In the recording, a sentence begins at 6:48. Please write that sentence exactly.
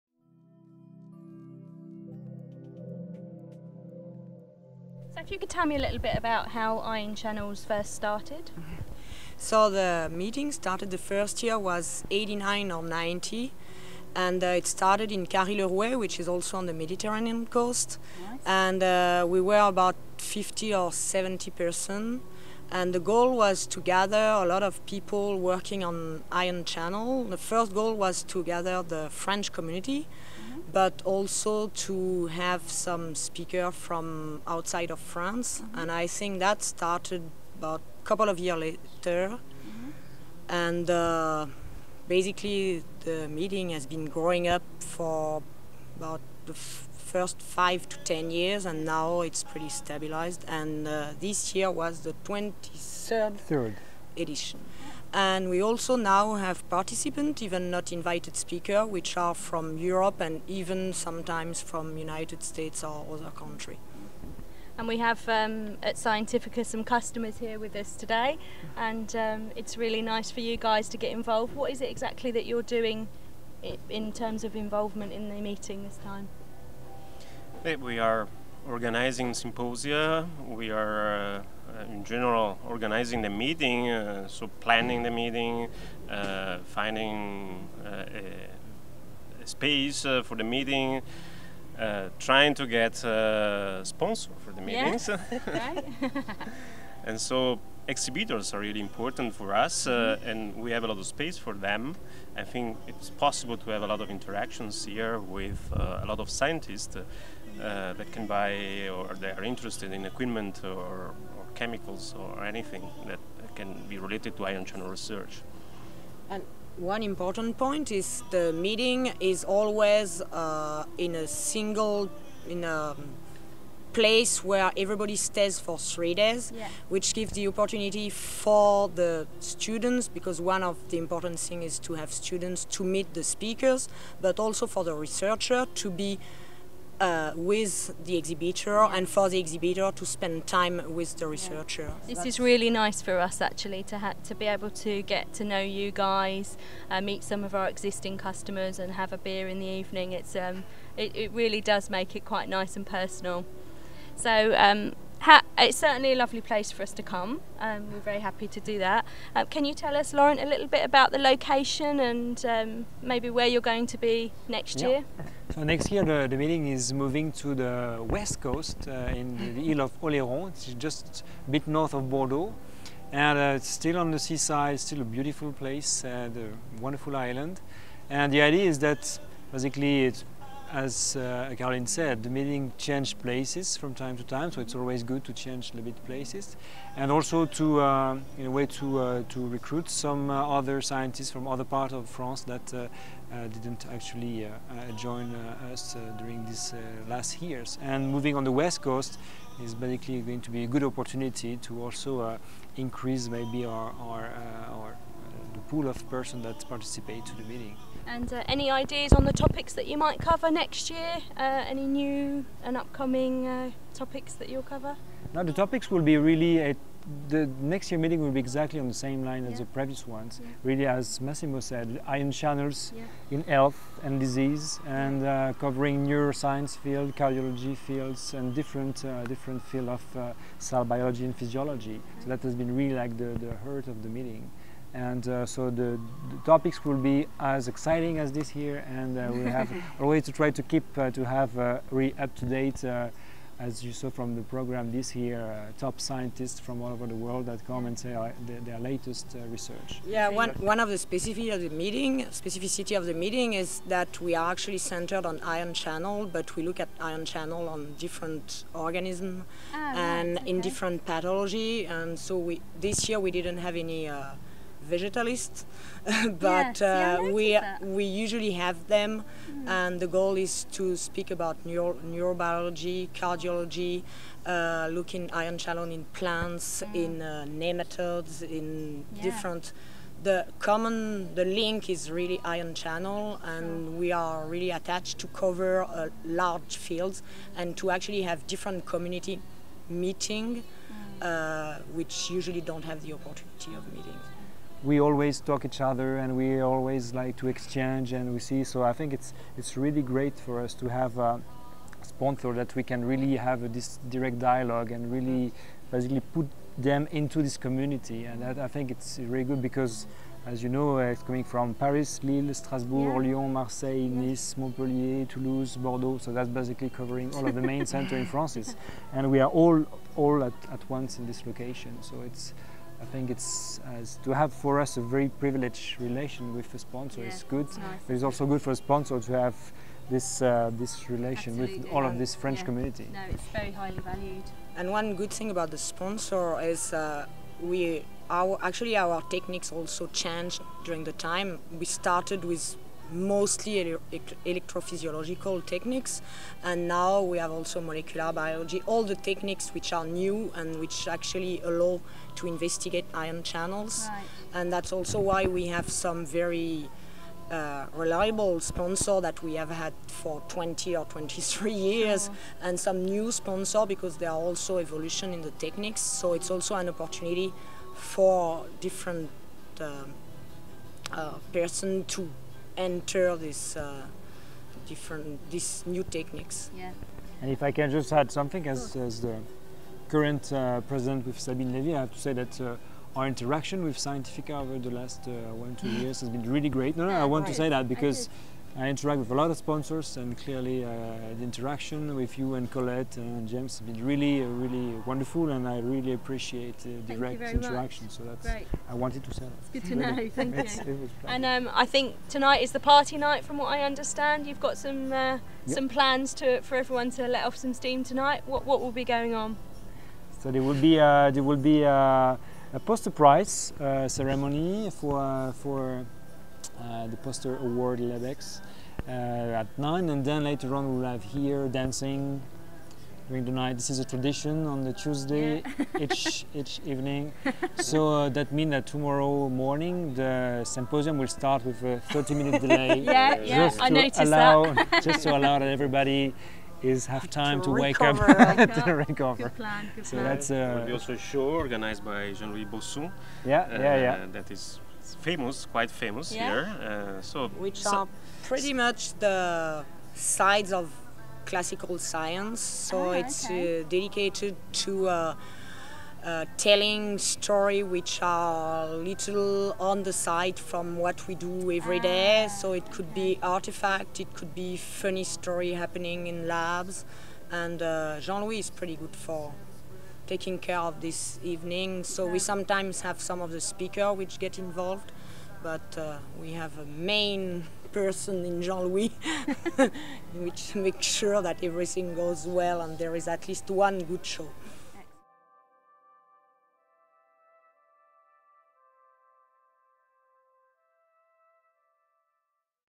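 What, what will be going on?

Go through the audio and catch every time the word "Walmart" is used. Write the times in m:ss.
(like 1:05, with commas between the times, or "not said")
not said.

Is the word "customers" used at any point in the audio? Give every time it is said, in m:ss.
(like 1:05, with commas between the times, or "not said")
1:06, 2:28.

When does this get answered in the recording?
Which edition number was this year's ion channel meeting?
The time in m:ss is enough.
0:52.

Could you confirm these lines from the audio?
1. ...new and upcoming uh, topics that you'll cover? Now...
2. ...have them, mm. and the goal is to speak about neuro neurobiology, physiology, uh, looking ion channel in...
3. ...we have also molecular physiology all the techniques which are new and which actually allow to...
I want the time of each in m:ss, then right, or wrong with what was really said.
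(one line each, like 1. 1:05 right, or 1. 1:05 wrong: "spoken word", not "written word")
1. 3:31 right
2. 4:28 wrong: "cardiology", not "physiology"
3. 5:47 wrong: "biology", not "physiology".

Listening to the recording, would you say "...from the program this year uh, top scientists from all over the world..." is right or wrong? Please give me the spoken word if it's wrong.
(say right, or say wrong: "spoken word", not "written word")
right.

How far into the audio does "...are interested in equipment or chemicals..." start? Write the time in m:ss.
1:49.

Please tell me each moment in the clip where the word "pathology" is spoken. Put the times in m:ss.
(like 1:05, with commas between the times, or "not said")
4:21.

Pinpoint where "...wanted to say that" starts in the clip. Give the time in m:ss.
6:38.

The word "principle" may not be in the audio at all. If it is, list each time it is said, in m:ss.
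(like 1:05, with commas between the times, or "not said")
not said.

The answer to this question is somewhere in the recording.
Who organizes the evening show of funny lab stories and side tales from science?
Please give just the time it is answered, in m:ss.
7:22.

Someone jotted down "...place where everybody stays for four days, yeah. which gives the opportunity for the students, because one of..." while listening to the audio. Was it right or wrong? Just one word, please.
wrong.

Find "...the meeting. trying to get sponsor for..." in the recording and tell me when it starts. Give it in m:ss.
1:30.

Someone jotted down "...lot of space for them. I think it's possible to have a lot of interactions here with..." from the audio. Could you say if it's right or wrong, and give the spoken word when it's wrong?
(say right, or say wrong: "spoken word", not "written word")
right.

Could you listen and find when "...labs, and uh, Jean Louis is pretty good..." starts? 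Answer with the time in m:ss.
7:46.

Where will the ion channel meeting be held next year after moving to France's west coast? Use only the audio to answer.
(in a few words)
Isle of Oléron.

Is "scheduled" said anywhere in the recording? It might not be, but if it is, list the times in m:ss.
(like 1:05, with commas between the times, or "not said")
not said.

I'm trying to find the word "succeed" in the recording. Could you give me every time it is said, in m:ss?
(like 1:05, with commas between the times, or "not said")
not said.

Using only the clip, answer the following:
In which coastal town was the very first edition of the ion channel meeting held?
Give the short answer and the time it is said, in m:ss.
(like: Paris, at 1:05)
Carry-le-Rouet, at 0:15.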